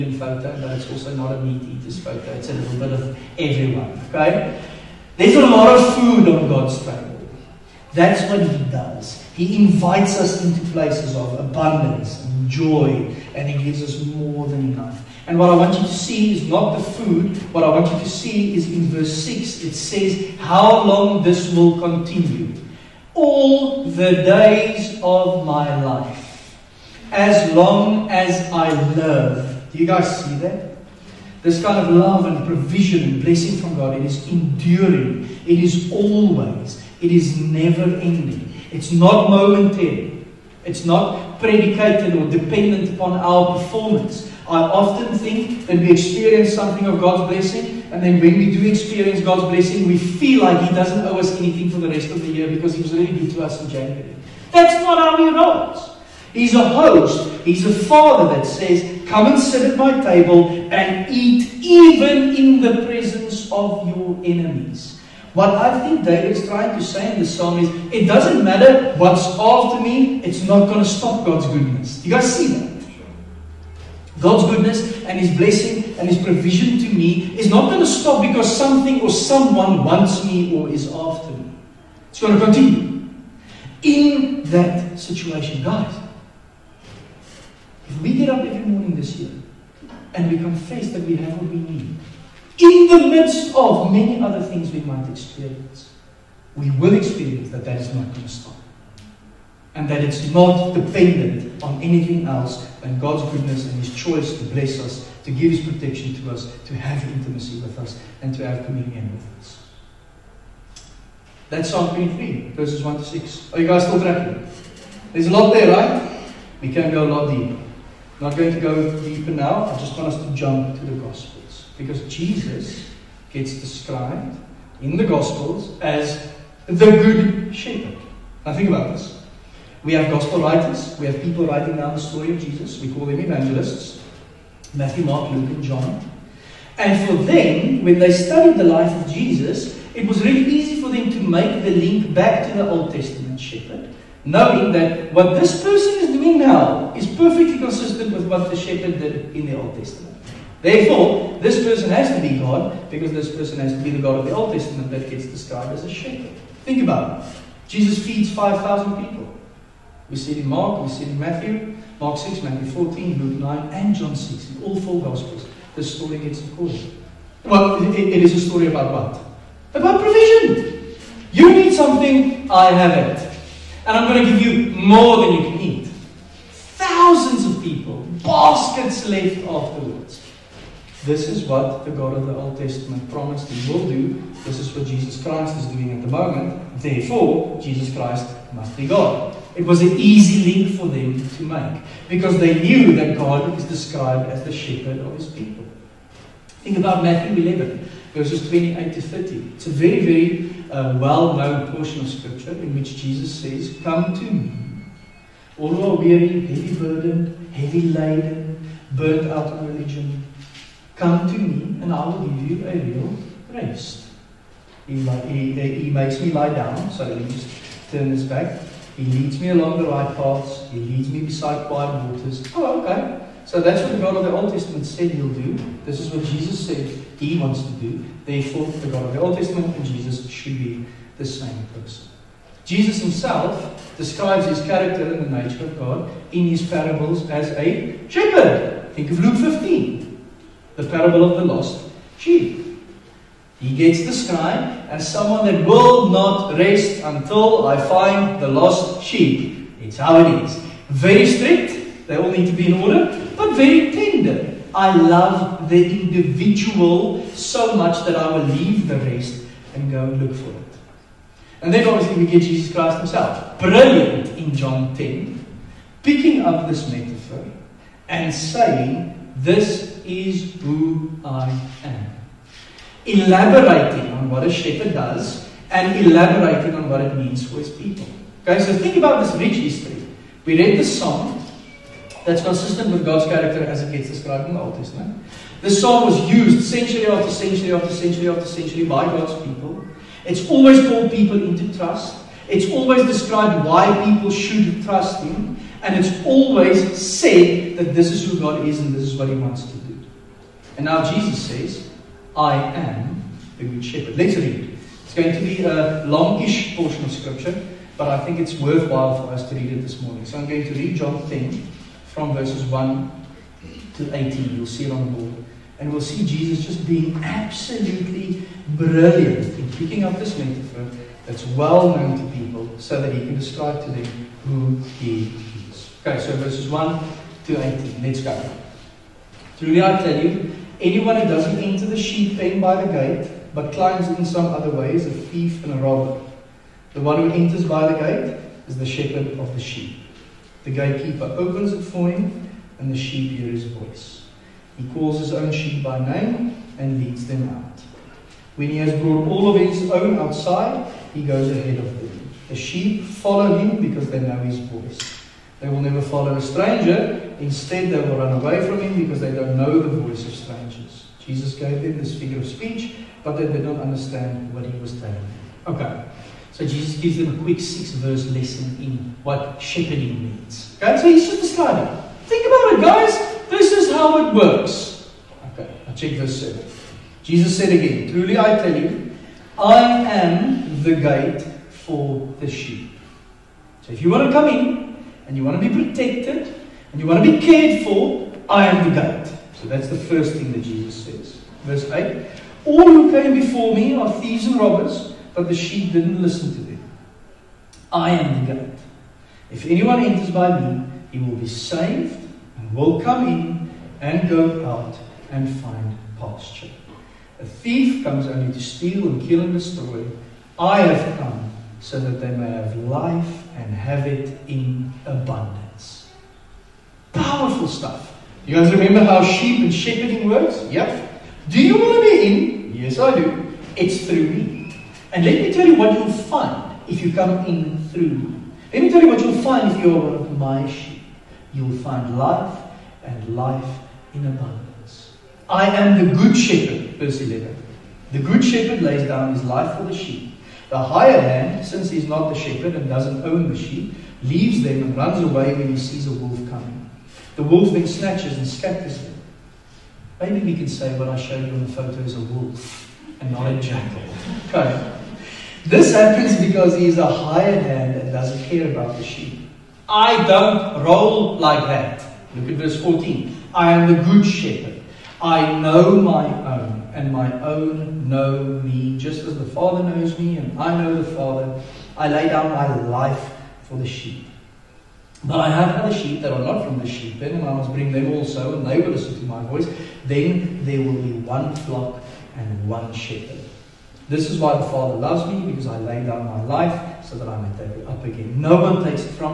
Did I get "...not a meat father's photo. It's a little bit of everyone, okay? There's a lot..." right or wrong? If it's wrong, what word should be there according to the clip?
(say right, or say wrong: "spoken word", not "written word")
wrong: "eater", not "father".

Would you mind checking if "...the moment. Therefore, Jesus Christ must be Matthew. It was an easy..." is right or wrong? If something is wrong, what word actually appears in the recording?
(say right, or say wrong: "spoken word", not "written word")
wrong: "God", not "Matthew".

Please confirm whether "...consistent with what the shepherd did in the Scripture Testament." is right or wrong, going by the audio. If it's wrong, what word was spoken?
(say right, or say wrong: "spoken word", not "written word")
wrong: "Old", not "Scripture".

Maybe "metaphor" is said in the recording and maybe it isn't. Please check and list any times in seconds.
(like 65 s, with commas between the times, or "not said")
266 s, 320 s.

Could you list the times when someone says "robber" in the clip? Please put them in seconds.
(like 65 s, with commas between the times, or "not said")
335 s, 394 s.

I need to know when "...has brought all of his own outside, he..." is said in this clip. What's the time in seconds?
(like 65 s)
348 s.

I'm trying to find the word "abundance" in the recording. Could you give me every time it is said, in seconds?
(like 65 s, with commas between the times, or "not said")
11 s, 415 s, 434 s.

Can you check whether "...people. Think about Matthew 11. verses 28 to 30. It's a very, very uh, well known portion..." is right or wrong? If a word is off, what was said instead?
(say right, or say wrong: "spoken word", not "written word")
right.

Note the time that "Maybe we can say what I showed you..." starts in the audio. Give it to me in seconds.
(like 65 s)
450 s.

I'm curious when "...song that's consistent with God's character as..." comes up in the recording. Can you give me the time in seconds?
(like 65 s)
280 s.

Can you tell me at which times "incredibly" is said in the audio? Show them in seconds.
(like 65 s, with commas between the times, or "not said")
not said.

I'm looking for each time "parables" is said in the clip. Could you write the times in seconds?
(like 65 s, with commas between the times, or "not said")
236 s, 240 s.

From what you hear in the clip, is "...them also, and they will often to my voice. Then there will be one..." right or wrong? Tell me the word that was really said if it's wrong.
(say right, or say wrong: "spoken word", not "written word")
wrong: "listen", not "often".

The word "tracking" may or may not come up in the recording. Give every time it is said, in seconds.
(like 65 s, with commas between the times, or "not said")
113 s.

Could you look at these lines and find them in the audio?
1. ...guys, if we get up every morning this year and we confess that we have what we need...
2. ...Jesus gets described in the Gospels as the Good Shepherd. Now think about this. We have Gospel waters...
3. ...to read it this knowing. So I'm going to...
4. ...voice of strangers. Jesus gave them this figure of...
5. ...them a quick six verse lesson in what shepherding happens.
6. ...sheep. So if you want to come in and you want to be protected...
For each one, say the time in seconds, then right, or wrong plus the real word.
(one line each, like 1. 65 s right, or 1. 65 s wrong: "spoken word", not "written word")
1. 85 s right
2. 122 s wrong: "writers", not "waters"
3. 309 s wrong: "morning", not "knowing"
4. 359 s right
5. 367 s wrong: "means", not "happens"
6. 382 s right.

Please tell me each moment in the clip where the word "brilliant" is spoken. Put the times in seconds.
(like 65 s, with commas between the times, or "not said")
263 s, 318 s.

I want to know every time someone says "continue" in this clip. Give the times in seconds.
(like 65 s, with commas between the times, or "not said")
21 s, 82 s.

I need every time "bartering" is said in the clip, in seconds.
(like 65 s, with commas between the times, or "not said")
not said.